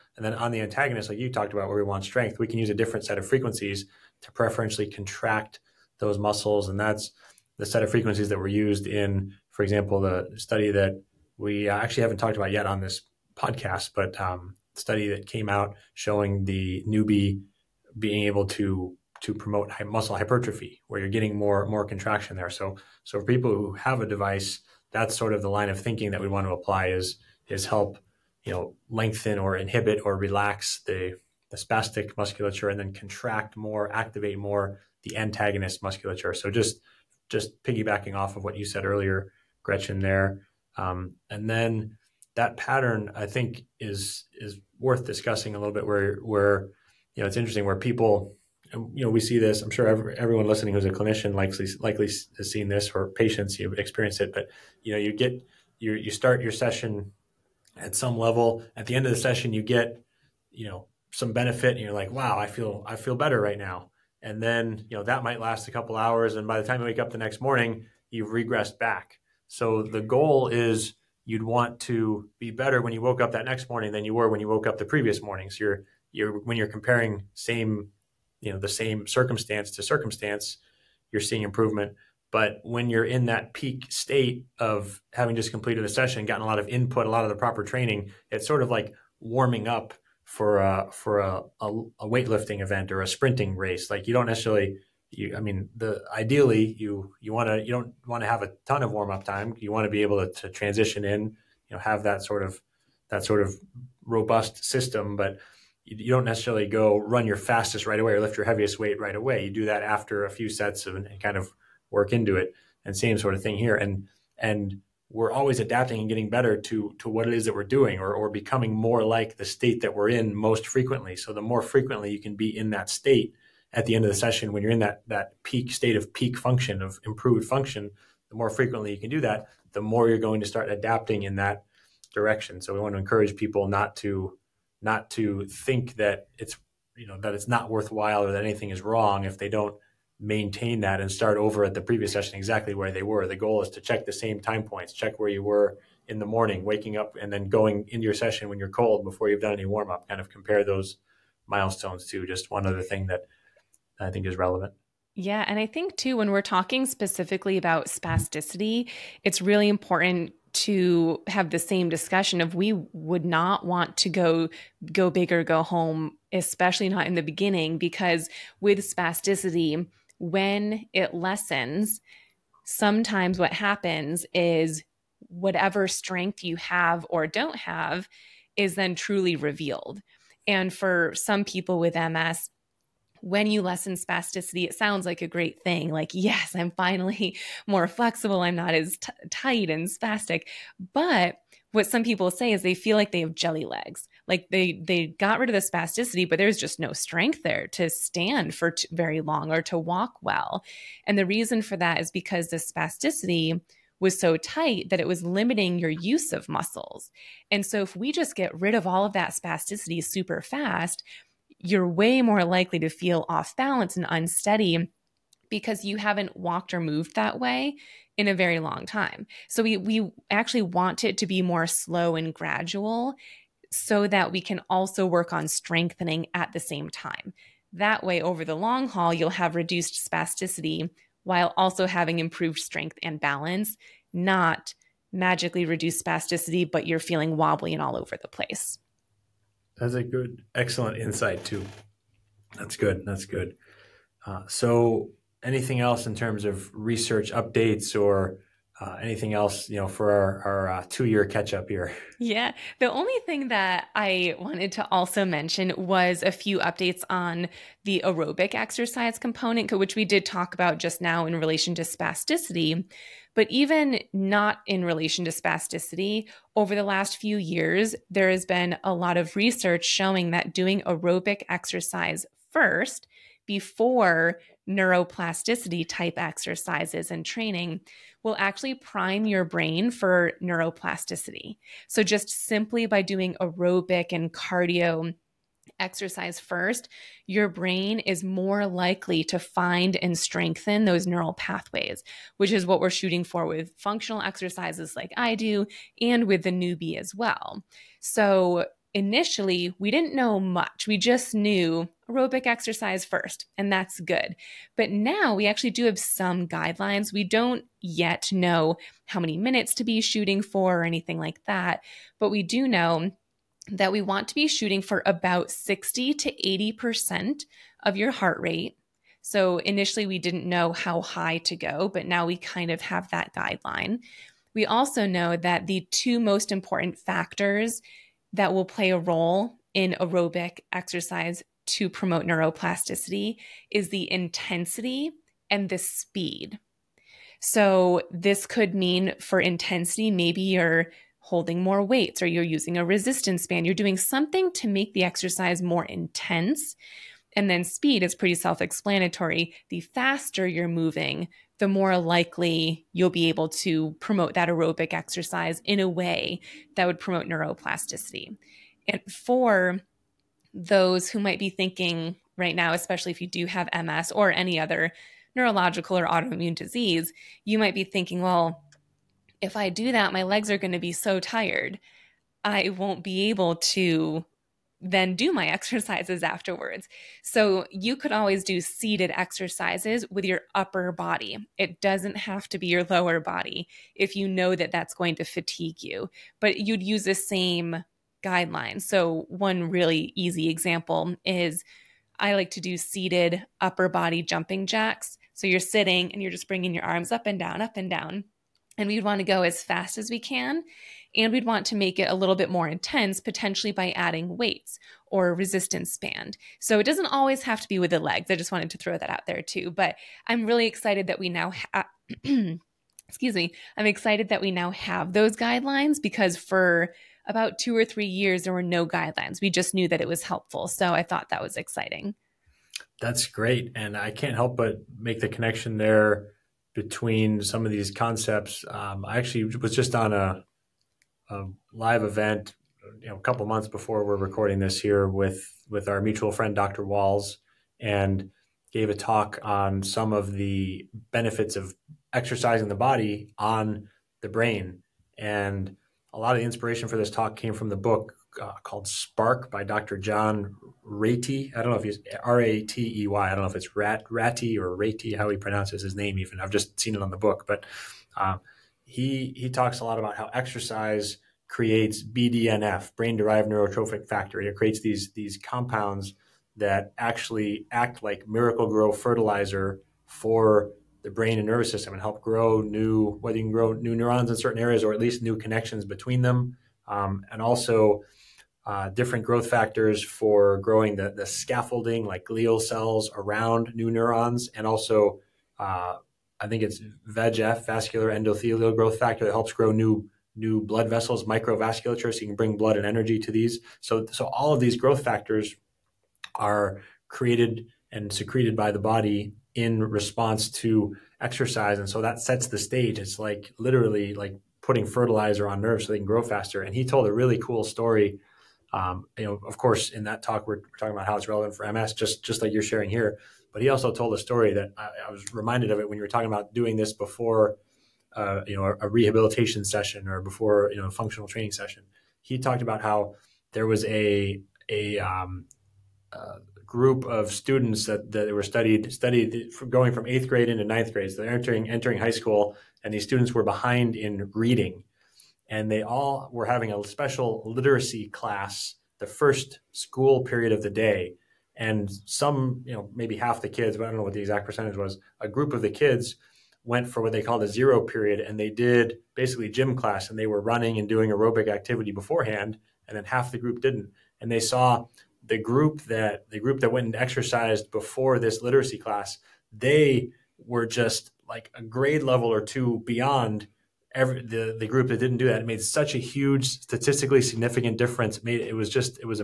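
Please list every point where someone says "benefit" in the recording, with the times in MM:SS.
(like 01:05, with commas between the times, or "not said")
01:01, 07:21.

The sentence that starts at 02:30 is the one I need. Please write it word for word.
Kind of compare those milestones to just one other thing that I think is relevant.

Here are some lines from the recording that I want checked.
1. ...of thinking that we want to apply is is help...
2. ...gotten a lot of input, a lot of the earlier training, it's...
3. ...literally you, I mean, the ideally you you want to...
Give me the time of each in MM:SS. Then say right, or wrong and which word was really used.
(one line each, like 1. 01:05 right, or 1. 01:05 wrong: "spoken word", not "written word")
1. 00:25 right
2. 01:26 wrong: "proper", not "earlier"
3. 01:34 wrong: "necessarily", not "literally".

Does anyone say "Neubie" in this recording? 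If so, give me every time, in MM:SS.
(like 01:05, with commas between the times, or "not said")
00:16, 04:56.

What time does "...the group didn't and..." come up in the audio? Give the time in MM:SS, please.
09:13.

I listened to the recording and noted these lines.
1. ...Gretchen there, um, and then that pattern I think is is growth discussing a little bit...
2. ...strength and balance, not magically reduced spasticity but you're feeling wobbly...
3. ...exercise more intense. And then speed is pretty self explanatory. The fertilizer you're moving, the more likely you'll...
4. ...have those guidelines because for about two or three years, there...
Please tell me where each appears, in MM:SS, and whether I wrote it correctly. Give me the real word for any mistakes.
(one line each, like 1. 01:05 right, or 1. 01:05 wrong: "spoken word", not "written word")
1. 00:39 wrong: "worth", not "growth"
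2. 03:52 right
3. 05:45 wrong: "faster", not "fertilizer"
4. 06:54 right.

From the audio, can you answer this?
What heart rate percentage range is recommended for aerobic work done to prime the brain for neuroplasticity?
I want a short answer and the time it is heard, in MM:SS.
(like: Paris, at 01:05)
60 to 80%, at 05:15.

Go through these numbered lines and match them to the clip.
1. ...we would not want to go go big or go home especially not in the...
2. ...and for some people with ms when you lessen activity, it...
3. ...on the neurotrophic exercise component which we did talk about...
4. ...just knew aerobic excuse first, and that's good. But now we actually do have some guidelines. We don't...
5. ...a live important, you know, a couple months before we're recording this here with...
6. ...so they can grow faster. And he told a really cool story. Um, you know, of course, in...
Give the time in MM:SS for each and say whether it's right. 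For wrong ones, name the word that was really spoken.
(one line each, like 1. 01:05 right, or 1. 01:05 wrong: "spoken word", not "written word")
1. 02:42 right
2. 03:00 wrong: "spasticity", not "activity"
3. 04:17 wrong: "aerobic", not "neurotrophic"
4. 05:00 wrong: "exercise", not "excuse"
5. 07:11 wrong: "event", not "important"
6. 08:25 right.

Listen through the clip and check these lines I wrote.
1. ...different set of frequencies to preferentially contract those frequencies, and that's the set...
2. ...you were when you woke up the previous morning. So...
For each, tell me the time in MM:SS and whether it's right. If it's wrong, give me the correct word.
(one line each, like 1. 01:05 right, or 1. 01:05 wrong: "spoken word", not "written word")
1. 00:02 wrong: "muscles", not "frequencies"
2. 01:14 right.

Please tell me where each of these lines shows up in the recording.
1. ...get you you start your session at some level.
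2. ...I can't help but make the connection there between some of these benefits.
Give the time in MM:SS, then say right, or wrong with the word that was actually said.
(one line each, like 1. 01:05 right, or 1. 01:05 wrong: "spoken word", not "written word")
1. 00:55 right
2. 07:03 wrong: "concepts", not "benefits".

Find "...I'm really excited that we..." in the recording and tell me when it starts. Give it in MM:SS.
06:50.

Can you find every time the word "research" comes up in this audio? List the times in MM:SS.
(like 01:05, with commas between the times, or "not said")
04:06, 04:29.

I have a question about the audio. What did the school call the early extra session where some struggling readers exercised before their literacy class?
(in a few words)
zero period.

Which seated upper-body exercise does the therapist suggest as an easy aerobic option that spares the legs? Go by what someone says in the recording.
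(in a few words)
upper body jumping jacks.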